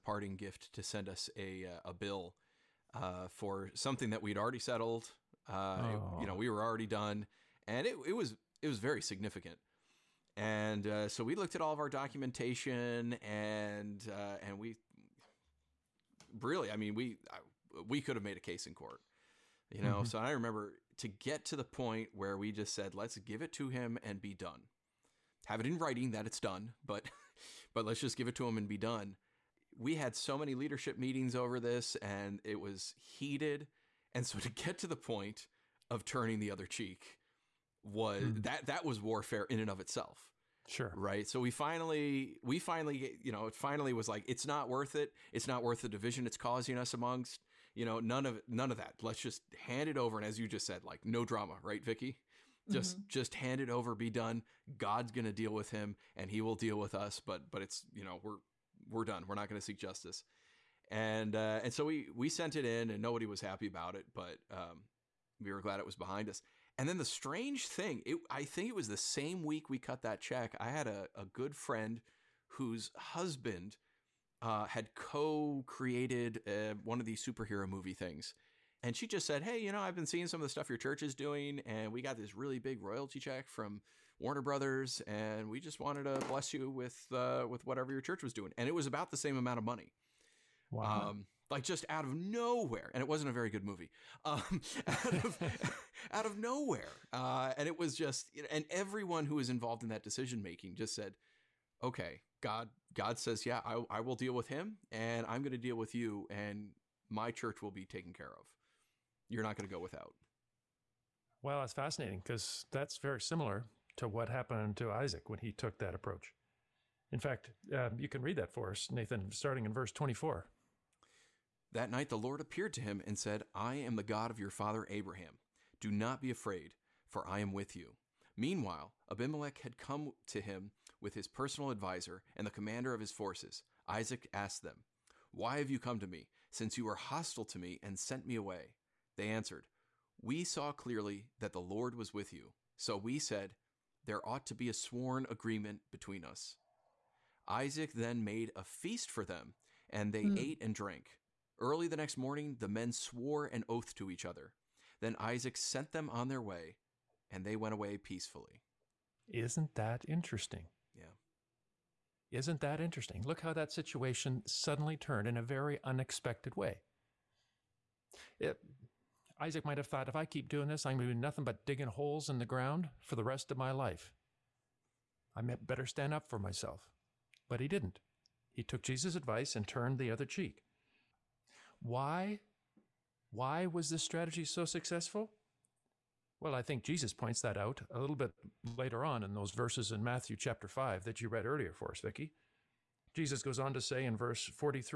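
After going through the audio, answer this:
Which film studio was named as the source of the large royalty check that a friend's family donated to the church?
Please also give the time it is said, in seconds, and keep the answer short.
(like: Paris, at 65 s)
Warner Brothers, at 84 s.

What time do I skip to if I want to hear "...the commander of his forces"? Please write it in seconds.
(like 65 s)
132 s.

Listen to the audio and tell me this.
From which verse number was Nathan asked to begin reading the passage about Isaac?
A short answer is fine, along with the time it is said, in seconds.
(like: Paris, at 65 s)
24, at 119 s.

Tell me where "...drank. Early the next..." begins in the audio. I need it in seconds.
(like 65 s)
150 s.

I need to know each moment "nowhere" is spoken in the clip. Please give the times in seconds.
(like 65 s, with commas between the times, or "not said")
92 s, 96 s.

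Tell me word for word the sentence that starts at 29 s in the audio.
We had so many leadership meetings over this and it was heated.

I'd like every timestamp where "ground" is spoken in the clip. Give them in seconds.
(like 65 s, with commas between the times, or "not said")
172 s.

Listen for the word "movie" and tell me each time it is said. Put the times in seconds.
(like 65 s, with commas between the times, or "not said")
77 s, 93 s.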